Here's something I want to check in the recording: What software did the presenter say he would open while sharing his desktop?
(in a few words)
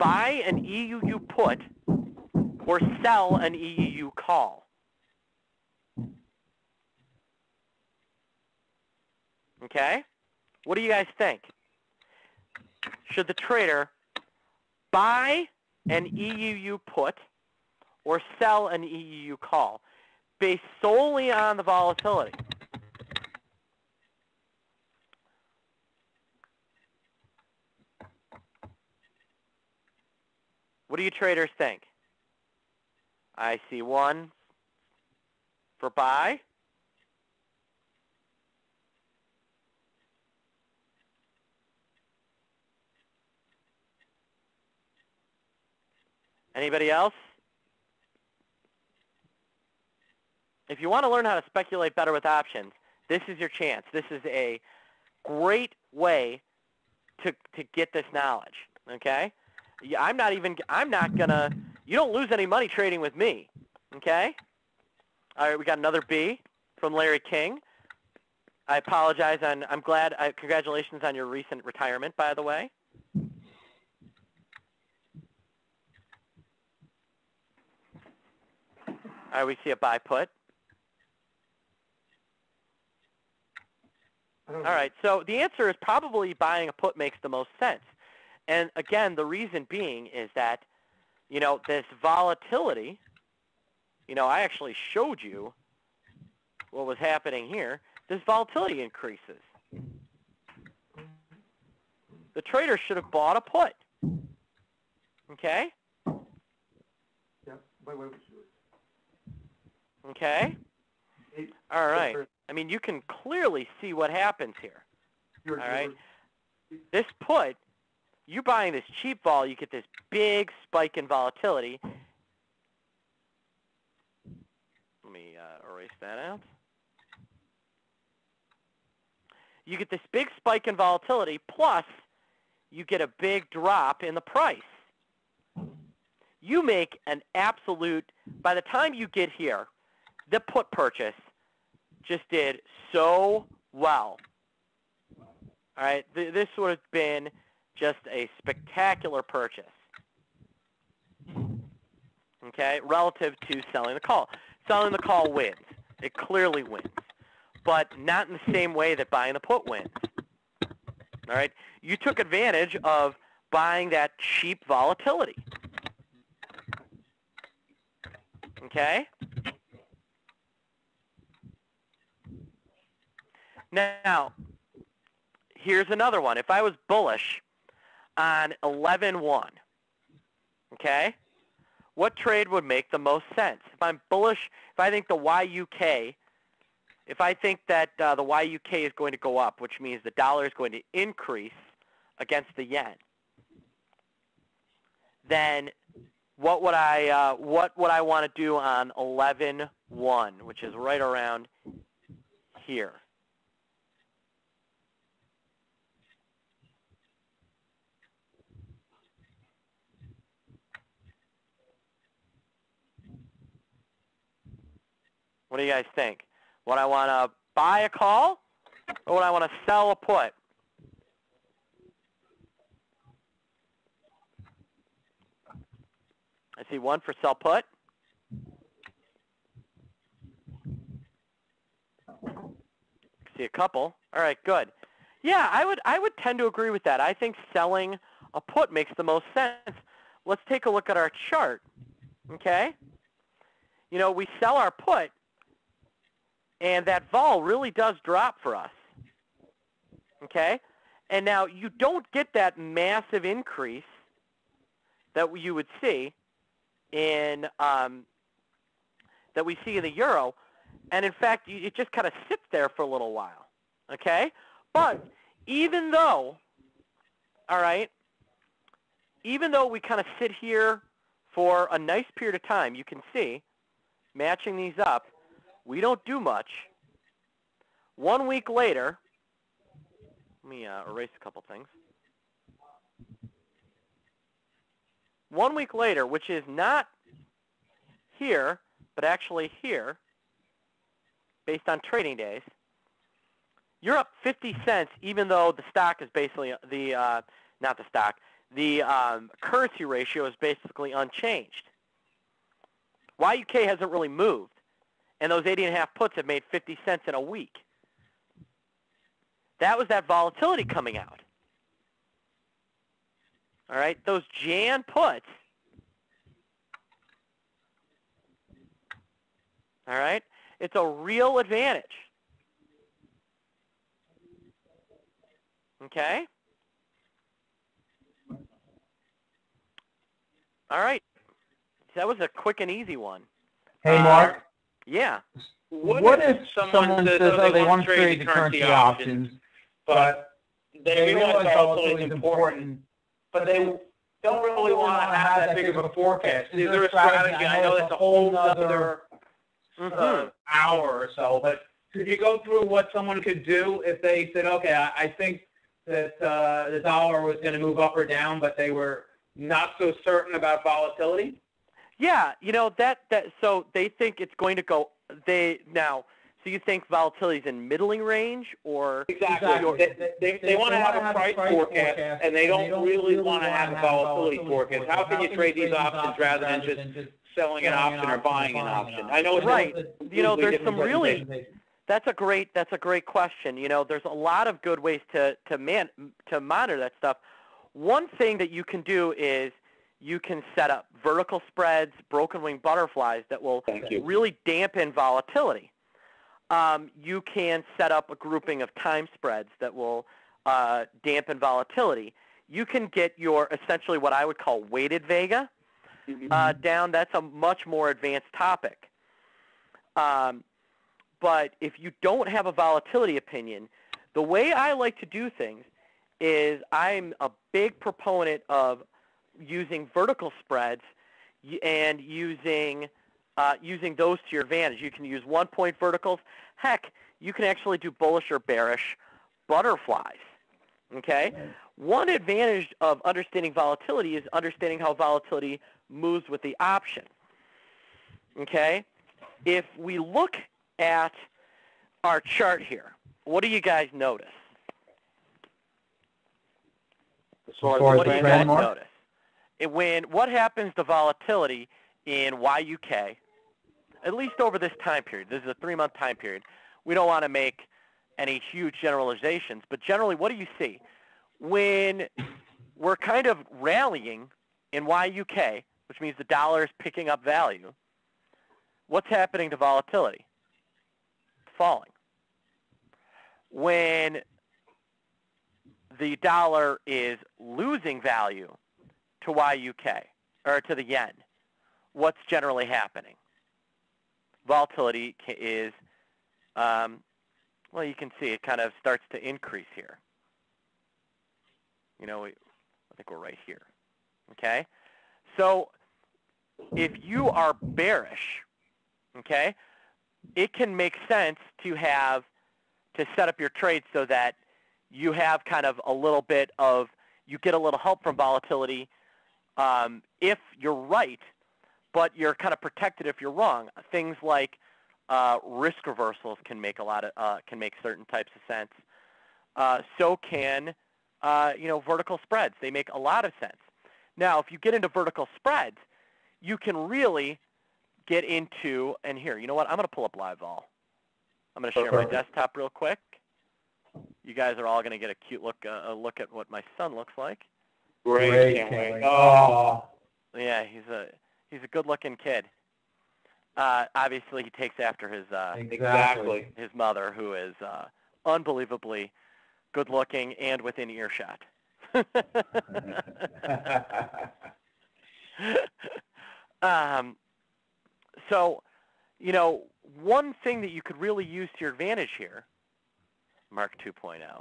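LiveVol.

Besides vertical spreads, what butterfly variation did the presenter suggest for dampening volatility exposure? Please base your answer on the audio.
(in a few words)
Broken wing butterflies.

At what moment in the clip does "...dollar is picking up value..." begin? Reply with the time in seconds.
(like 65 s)
466 s.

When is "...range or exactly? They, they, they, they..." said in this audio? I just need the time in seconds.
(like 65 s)
367 s.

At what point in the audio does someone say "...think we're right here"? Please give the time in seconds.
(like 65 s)
492 s.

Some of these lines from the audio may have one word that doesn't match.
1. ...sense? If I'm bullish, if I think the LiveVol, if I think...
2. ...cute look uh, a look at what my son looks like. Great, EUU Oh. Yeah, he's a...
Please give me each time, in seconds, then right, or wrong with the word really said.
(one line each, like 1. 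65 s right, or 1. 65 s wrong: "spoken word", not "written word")
1. 183 s wrong: "YUK", not "LiveVol"
2. 535 s wrong: "Great", not "EUU".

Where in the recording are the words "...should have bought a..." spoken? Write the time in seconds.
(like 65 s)
102 s.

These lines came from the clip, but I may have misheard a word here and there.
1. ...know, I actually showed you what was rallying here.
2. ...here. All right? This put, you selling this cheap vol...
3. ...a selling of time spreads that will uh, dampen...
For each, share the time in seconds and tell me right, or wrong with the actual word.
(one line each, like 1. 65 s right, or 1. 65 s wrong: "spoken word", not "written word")
1. 94 s wrong: "happening", not "rallying"
2. 114 s wrong: "buying", not "selling"
3. 398 s wrong: "grouping", not "selling".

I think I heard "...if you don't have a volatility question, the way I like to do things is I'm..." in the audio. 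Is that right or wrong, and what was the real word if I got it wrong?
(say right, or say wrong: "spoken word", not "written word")
wrong: "opinion", not "question".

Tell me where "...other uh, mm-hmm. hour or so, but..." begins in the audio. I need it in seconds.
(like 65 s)
348 s.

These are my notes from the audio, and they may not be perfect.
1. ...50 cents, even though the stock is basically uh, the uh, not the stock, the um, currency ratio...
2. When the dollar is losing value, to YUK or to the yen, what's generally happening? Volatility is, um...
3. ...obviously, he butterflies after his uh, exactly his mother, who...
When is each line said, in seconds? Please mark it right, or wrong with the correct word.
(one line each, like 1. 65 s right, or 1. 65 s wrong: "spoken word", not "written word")
1. 294 s right
2. 473 s right
3. 543 s wrong: "takes", not "butterflies".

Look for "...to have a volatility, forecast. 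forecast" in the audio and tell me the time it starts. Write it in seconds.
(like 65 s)
373 s.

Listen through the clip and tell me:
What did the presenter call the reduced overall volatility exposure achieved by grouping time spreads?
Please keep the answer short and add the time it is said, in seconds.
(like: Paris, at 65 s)
Weighted vega, at 404 s.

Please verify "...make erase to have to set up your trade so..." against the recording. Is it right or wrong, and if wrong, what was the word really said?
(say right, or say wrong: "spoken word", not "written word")
wrong: "sense", not "erase".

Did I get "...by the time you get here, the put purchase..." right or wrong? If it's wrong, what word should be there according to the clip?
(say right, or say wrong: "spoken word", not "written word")
right.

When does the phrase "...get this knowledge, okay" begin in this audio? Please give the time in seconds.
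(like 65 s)
57 s.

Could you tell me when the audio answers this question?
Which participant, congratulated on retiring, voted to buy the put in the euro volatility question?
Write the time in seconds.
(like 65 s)
66 s.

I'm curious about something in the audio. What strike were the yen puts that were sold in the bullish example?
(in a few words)
80.5.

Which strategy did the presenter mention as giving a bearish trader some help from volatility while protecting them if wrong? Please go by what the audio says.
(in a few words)
Risk reversals.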